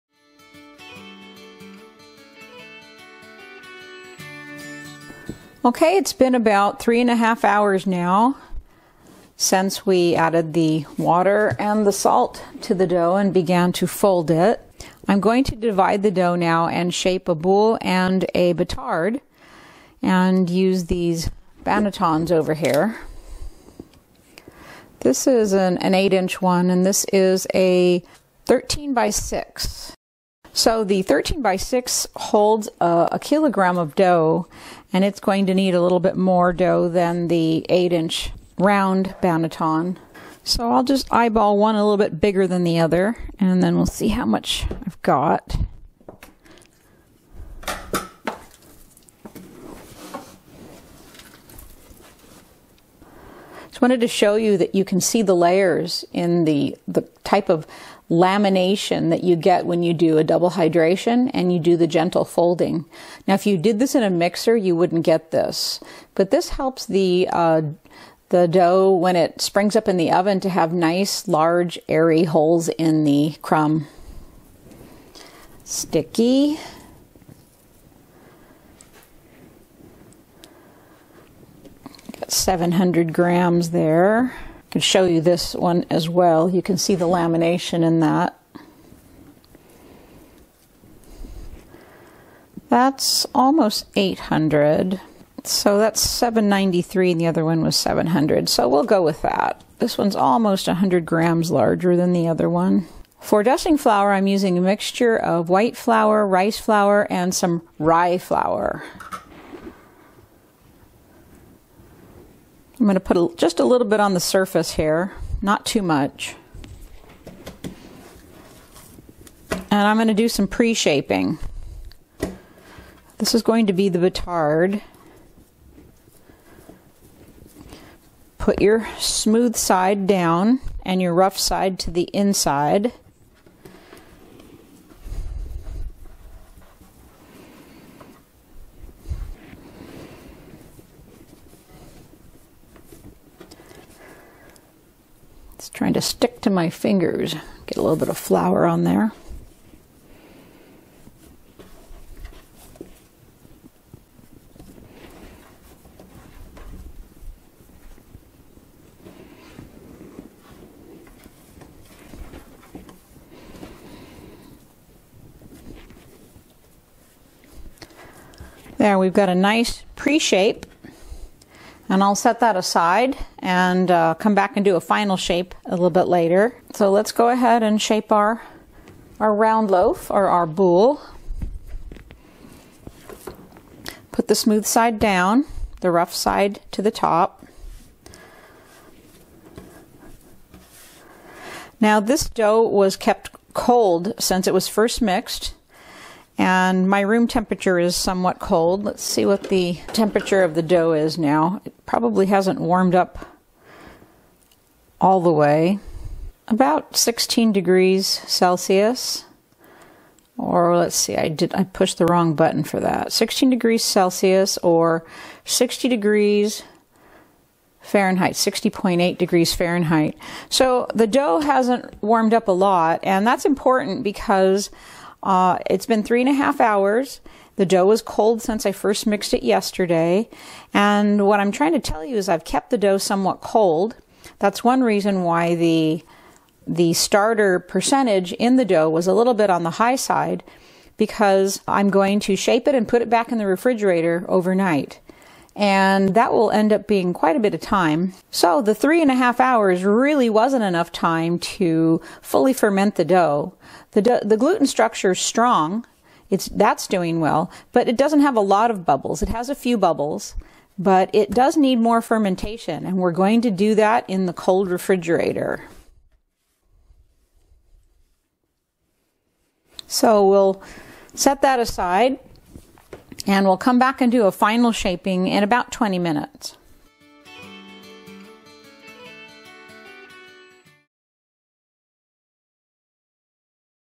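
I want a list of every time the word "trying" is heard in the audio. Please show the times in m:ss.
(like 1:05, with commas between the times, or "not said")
2:25, 3:51.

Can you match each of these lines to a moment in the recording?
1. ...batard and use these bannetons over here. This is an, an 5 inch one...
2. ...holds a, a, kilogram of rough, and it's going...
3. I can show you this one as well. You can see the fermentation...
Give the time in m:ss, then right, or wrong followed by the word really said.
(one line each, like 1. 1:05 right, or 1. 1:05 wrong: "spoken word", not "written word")
1. 0:18 wrong: "8", not "5"
2. 0:32 wrong: "dough", not "rough"
3. 1:24 wrong: "lamination", not "fermentation".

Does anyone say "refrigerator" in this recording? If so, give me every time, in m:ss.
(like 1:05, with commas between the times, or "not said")
4:03, 4:24.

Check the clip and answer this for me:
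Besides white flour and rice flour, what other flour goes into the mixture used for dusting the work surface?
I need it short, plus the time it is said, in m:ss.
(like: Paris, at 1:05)
rye flour, at 1:47.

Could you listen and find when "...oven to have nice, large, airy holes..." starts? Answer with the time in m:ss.
1:10.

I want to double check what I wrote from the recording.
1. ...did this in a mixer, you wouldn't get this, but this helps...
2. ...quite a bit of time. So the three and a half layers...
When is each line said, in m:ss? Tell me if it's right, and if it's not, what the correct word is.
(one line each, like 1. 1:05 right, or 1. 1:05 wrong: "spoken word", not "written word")
1. 1:03 right
2. 4:07 wrong: "hours", not "layers".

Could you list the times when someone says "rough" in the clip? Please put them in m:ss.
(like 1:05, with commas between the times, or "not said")
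2:11, 3:05.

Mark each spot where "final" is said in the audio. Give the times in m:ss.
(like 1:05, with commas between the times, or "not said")
2:54, 4:34.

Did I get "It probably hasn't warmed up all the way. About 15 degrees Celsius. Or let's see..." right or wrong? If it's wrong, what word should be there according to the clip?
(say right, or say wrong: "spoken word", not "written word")
wrong: "16", not "15".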